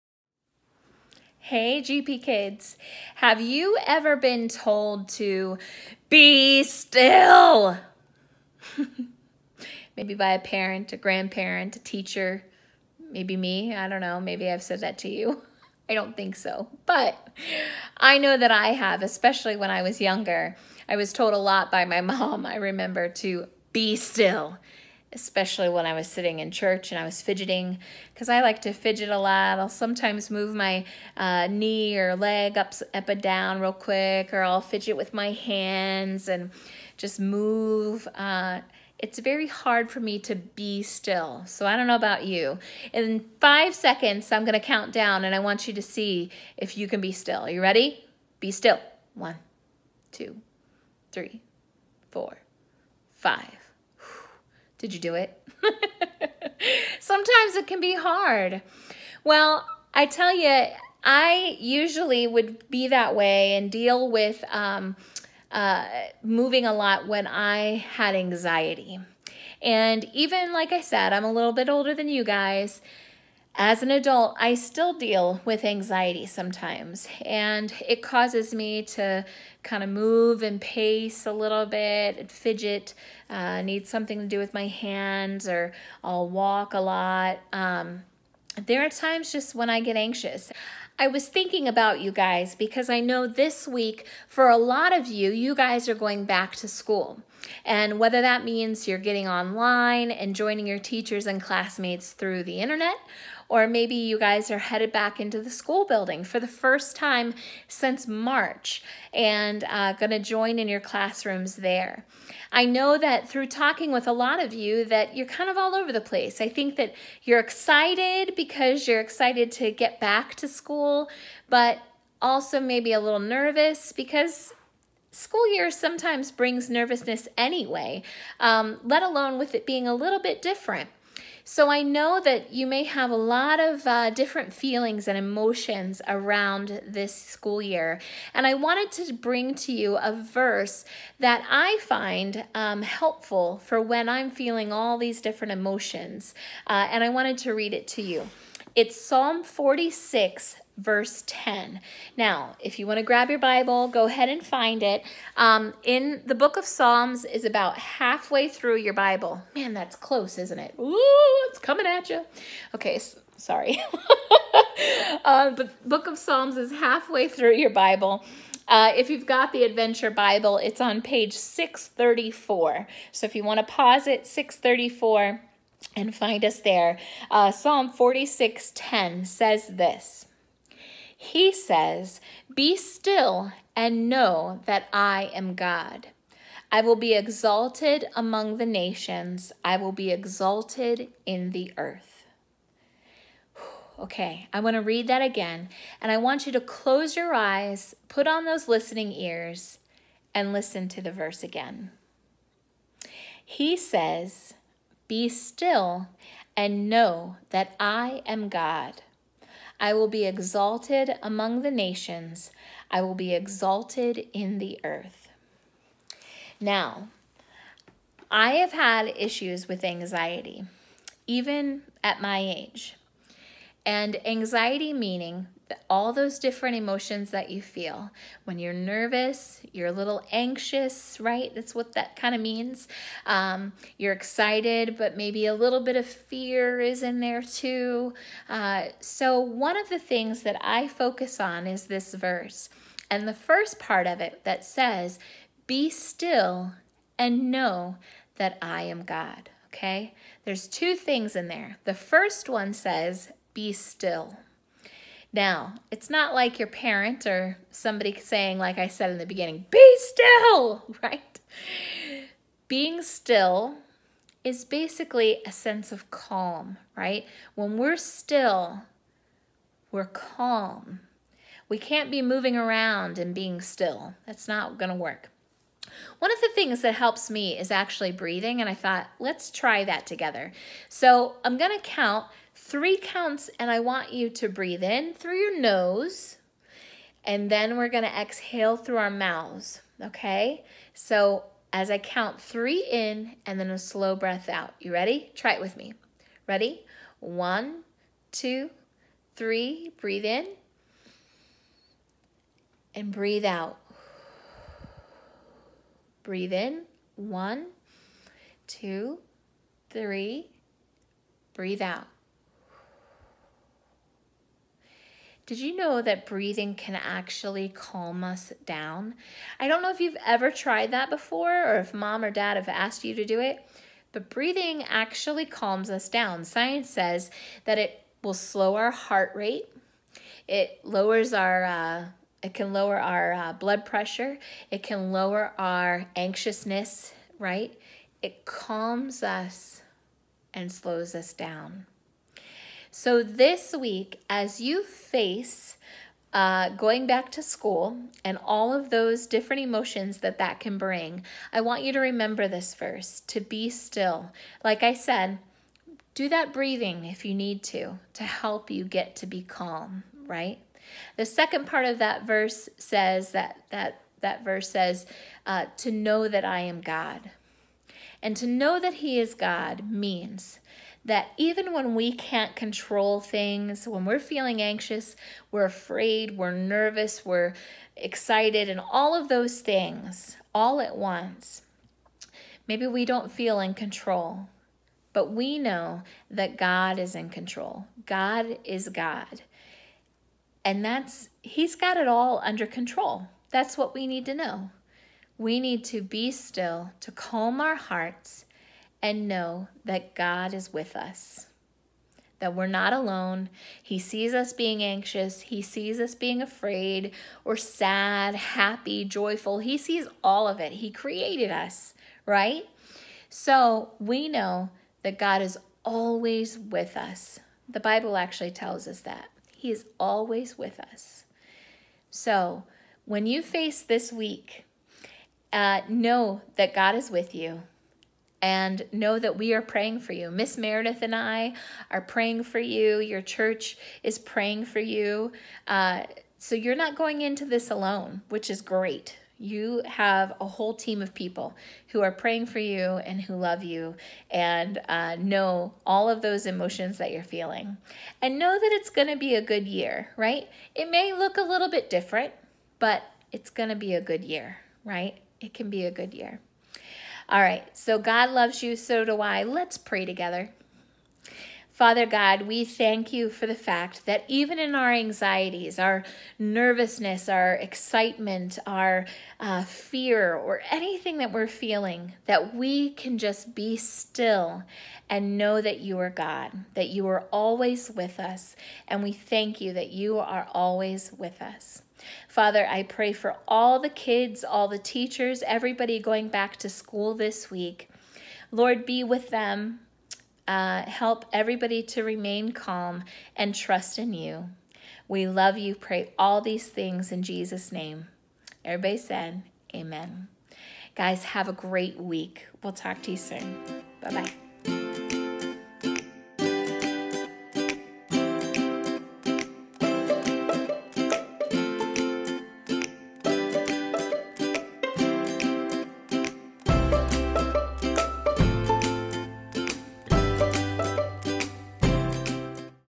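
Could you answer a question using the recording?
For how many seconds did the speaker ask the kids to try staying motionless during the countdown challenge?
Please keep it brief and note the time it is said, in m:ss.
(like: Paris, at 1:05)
5, at 0:43.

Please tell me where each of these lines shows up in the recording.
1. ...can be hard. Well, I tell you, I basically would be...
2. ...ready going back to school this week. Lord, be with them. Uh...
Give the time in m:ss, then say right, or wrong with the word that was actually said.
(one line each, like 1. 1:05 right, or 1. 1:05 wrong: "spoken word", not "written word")
1. 0:57 wrong: "usually", not "basically"
2. 8:05 wrong: "everybody", not "ready".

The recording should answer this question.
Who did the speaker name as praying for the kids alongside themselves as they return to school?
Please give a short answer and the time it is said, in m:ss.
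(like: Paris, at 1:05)
Miss Meredith, at 7:10.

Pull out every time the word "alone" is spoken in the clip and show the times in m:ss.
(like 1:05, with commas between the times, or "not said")
2:09, 6:42, 7:17.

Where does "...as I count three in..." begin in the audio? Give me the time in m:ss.
4:51.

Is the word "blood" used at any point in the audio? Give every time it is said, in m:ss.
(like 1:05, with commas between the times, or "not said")
5:33.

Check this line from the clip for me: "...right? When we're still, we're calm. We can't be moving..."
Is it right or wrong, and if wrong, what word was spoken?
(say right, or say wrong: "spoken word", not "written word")
right.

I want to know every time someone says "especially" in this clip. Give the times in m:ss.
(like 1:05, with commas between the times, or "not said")
0:19, 0:25.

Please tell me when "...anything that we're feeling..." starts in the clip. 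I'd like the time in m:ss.
7:50.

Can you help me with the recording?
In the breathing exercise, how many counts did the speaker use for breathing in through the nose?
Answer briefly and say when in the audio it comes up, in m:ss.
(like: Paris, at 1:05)
3, at 4:42.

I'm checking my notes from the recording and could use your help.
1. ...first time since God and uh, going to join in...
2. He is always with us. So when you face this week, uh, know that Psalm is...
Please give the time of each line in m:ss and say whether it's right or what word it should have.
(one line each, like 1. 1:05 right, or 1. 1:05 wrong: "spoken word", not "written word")
1. 1:46 wrong: "March", not "God"
2. 6:59 wrong: "God", not "Psalm".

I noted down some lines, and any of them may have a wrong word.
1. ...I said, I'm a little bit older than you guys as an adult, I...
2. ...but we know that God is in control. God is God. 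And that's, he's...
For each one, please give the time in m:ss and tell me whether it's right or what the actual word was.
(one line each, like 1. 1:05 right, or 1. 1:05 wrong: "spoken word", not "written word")
1. 1:10 right
2. 6:25 right.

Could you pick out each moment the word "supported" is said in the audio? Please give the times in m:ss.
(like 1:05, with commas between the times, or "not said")
not said.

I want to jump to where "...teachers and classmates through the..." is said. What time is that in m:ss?
1:40.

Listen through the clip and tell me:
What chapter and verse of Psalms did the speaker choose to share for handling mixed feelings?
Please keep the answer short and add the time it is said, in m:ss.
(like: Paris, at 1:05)
Psalm 46:10, at 2:29.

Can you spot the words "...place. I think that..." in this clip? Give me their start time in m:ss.
1:56.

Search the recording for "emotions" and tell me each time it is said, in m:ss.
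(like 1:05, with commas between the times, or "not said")
2:15, 2:25, 3:46, 5:49, 7:26.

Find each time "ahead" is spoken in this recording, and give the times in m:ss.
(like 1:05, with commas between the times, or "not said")
2:34.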